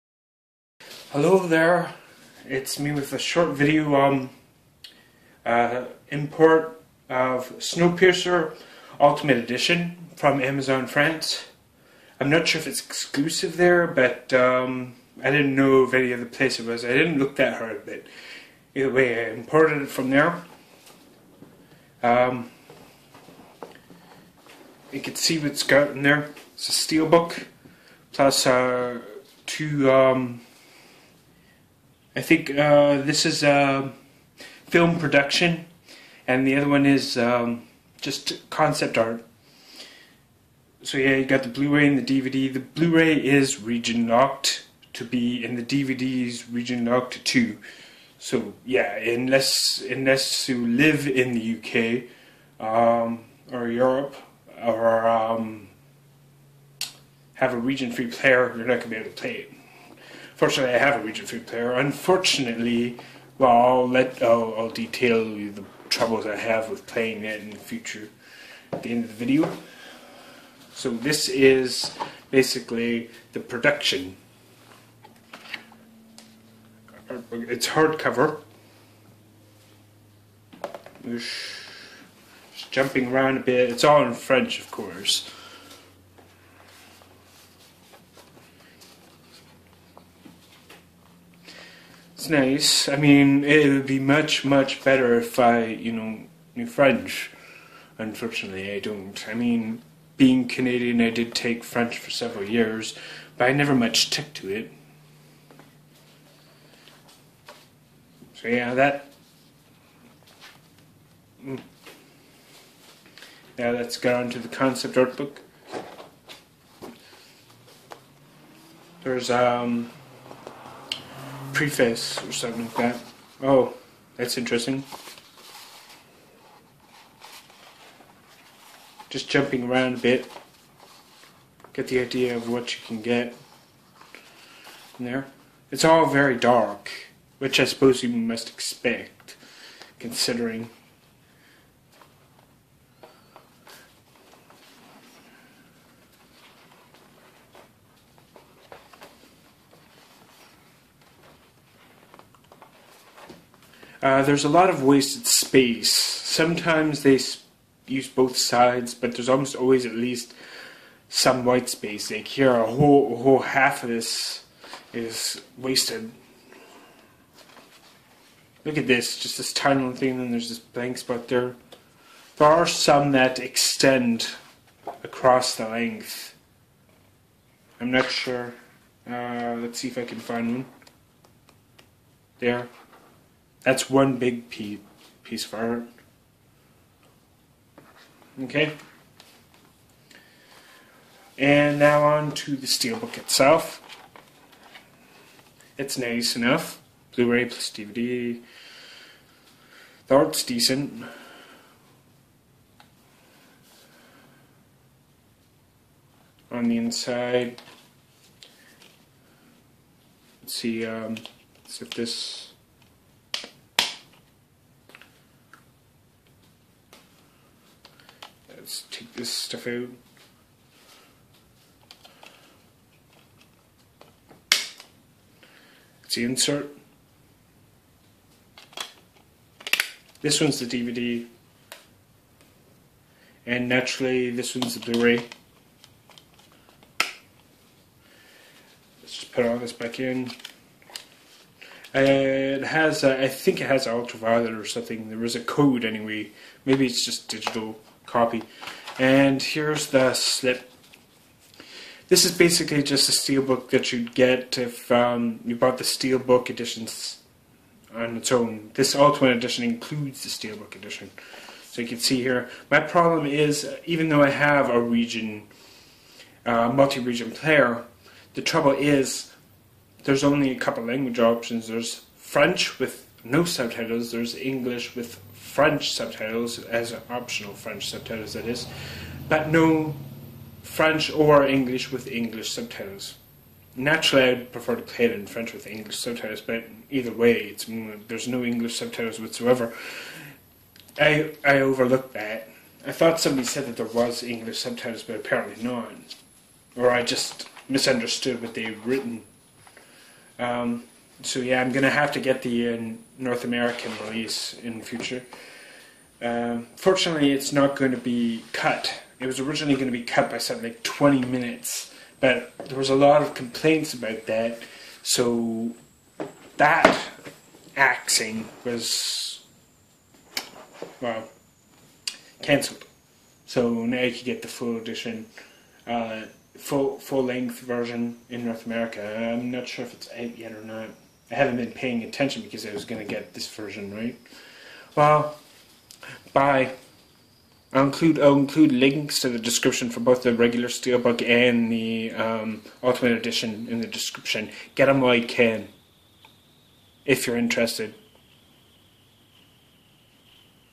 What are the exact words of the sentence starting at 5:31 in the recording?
I haven't been paying attention because I was going to get this version, right?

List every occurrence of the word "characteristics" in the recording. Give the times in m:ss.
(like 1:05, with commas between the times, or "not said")
not said.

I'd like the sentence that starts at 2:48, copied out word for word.
Look at this, just this tiny little thing, and then there's this blank spot there.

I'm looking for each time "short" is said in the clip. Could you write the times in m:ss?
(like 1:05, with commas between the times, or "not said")
0:03.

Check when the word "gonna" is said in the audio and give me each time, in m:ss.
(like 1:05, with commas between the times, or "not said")
0:58, 5:01.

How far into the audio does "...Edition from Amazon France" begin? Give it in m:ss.
0:09.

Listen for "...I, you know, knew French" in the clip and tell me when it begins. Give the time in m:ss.
1:35.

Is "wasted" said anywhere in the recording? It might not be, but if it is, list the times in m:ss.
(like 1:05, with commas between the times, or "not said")
2:34, 2:45.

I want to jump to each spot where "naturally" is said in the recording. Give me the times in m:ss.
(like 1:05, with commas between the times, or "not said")
3:53, 4:43.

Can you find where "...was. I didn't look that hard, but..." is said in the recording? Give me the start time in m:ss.
0:16.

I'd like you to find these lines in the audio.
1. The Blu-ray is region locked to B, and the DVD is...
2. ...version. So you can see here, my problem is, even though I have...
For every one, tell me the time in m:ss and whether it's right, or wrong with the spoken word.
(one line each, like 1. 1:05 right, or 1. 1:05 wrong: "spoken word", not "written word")
1. 0:42 right
2. 4:20 wrong: "edition", not "version".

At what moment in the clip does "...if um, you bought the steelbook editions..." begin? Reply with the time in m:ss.
4:14.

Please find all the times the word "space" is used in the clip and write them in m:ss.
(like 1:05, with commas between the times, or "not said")
2:35, 2:41.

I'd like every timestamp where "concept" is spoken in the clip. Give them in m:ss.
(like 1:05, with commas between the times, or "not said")
0:38, 1:54.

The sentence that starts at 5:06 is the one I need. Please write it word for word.
Um, fortunately, it's not going to be cut.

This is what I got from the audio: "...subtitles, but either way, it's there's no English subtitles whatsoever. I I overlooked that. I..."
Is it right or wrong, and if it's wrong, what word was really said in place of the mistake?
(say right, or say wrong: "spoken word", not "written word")
right.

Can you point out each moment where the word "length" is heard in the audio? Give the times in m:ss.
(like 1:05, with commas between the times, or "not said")
2:55, 5:27.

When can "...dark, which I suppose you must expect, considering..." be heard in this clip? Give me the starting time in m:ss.
2:16.